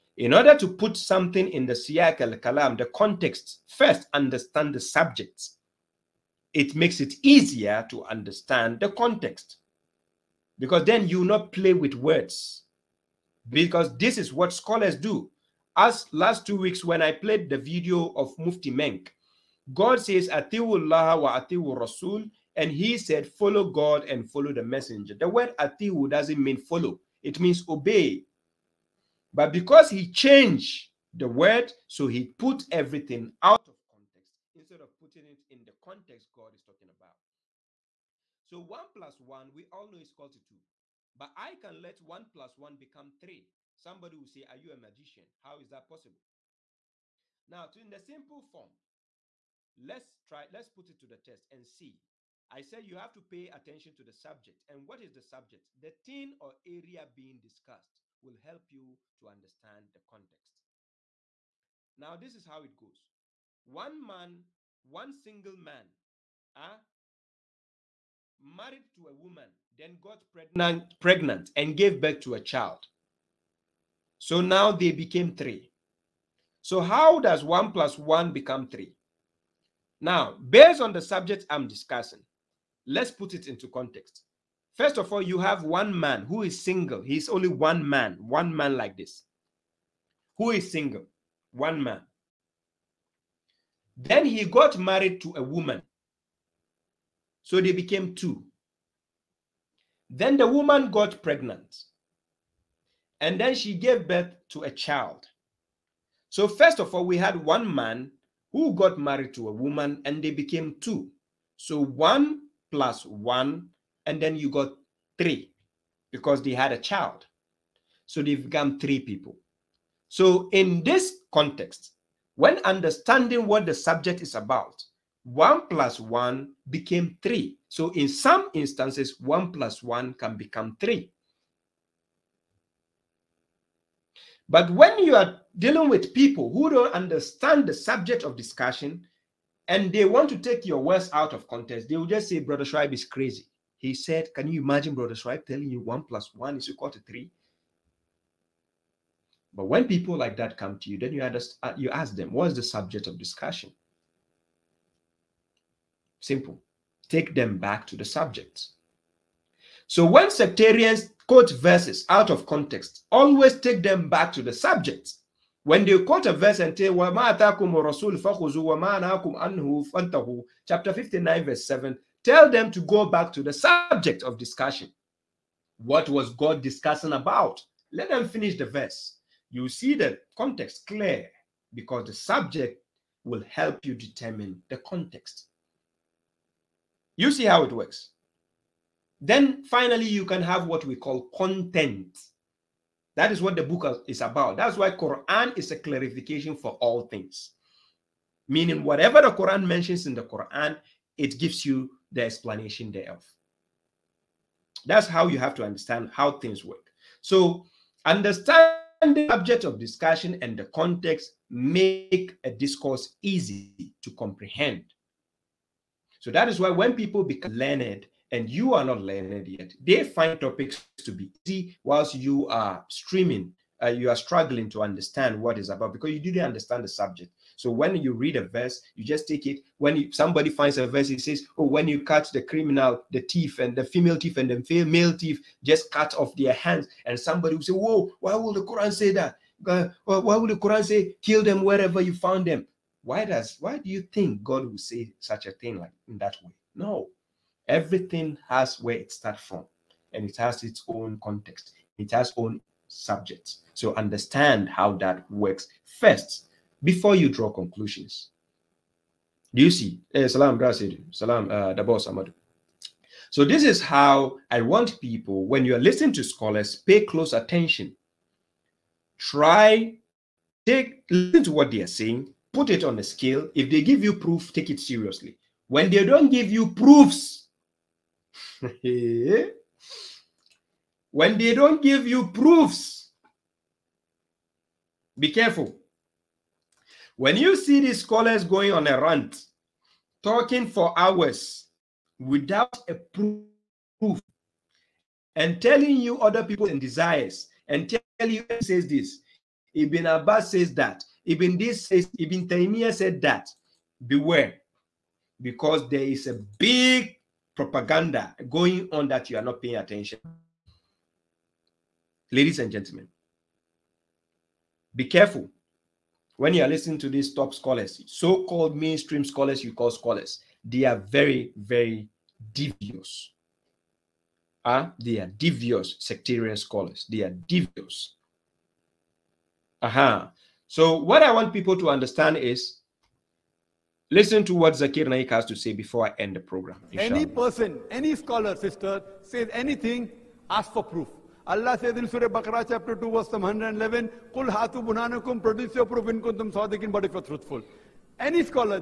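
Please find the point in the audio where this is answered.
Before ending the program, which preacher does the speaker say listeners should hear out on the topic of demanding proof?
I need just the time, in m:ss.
5:34.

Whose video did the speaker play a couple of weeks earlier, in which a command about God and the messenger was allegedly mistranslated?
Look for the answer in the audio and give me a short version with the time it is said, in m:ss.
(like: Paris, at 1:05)
Mufti Menk, at 0:18.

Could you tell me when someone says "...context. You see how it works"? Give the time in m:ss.
3:04.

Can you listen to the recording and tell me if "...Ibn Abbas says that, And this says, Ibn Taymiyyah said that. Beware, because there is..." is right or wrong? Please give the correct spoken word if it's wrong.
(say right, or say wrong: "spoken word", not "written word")
wrong: "Ibn", not "And".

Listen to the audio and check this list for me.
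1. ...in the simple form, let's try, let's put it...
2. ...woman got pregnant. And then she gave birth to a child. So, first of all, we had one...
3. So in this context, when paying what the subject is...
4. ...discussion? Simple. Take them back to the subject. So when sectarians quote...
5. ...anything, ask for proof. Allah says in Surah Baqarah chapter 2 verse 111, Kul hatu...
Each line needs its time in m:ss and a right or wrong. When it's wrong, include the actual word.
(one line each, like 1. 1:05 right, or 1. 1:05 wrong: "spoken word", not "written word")
1. 0:47 right
2. 1:40 right
3. 2:00 wrong: "understanding", not "paying"
4. 2:33 right
5. 5:39 right.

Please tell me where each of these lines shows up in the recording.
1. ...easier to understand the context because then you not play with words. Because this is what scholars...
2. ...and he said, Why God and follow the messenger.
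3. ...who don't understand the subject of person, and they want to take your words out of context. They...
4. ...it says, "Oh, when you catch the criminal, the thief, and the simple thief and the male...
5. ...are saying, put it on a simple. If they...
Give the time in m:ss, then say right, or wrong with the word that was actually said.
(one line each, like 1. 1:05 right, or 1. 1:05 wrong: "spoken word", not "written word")
1. 0:07 right
2. 0:22 wrong: "Follow", not "Why"
3. 2:16 wrong: "discussion", not "person"
4. 3:51 wrong: "female", not "simple"
5. 4:31 wrong: "scale", not "simple".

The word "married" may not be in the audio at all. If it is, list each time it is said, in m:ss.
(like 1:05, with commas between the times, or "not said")
1:08, 1:34, 1:48.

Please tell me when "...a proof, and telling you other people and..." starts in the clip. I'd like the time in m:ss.
4:52.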